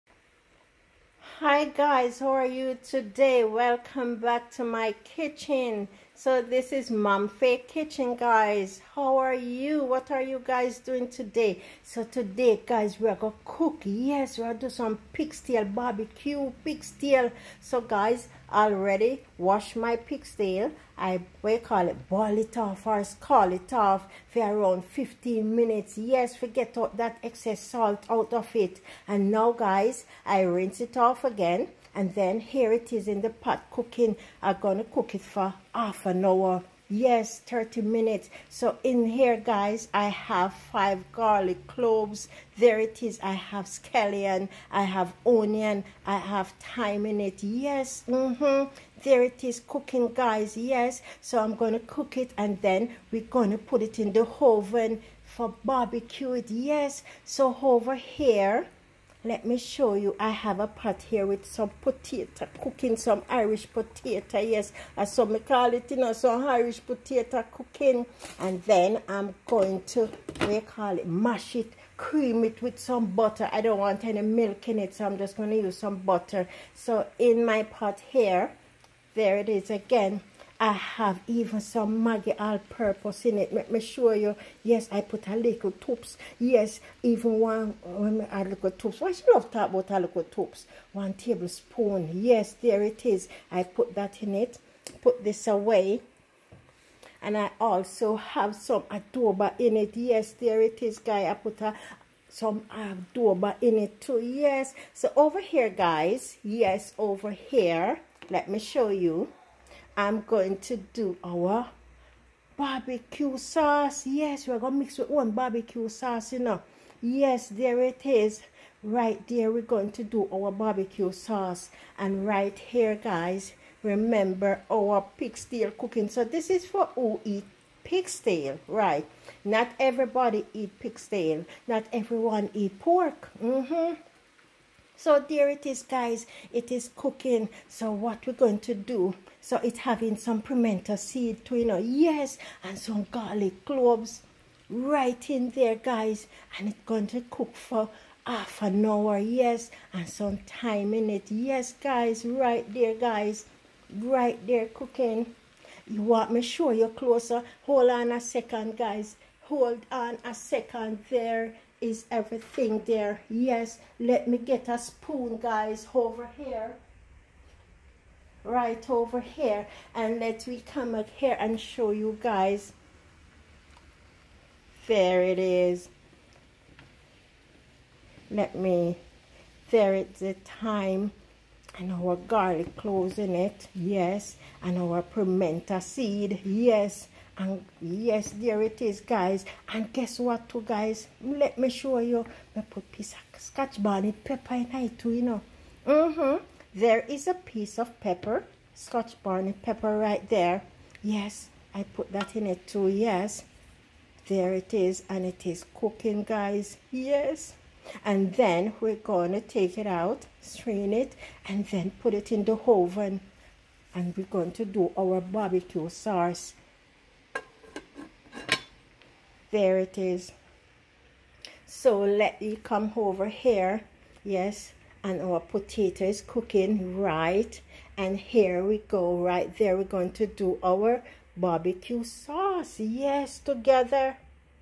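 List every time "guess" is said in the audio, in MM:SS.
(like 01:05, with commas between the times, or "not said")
03:09.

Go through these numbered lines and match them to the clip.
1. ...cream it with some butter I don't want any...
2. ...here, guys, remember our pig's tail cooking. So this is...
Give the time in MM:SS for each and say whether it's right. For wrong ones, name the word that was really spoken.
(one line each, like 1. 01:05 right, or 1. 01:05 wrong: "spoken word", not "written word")
1. 01:11 right
2. 02:02 right.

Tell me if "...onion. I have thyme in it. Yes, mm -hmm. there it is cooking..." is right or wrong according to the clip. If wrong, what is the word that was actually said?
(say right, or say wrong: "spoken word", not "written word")
right.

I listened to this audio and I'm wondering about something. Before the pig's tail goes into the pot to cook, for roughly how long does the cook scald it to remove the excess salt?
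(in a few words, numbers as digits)
15 minutes.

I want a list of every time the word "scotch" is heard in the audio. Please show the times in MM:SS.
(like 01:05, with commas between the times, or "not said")
03:13, 03:18.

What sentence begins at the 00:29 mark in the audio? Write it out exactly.
And now guys, I rinse it off again and then here it is in the pot cooking.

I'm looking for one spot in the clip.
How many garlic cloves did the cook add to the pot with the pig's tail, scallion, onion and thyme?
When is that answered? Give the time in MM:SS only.
00:40.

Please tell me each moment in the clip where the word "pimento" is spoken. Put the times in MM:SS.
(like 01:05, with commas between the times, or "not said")
02:20, 03:05.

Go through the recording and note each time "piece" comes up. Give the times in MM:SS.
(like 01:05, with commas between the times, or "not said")
03:12, 03:17.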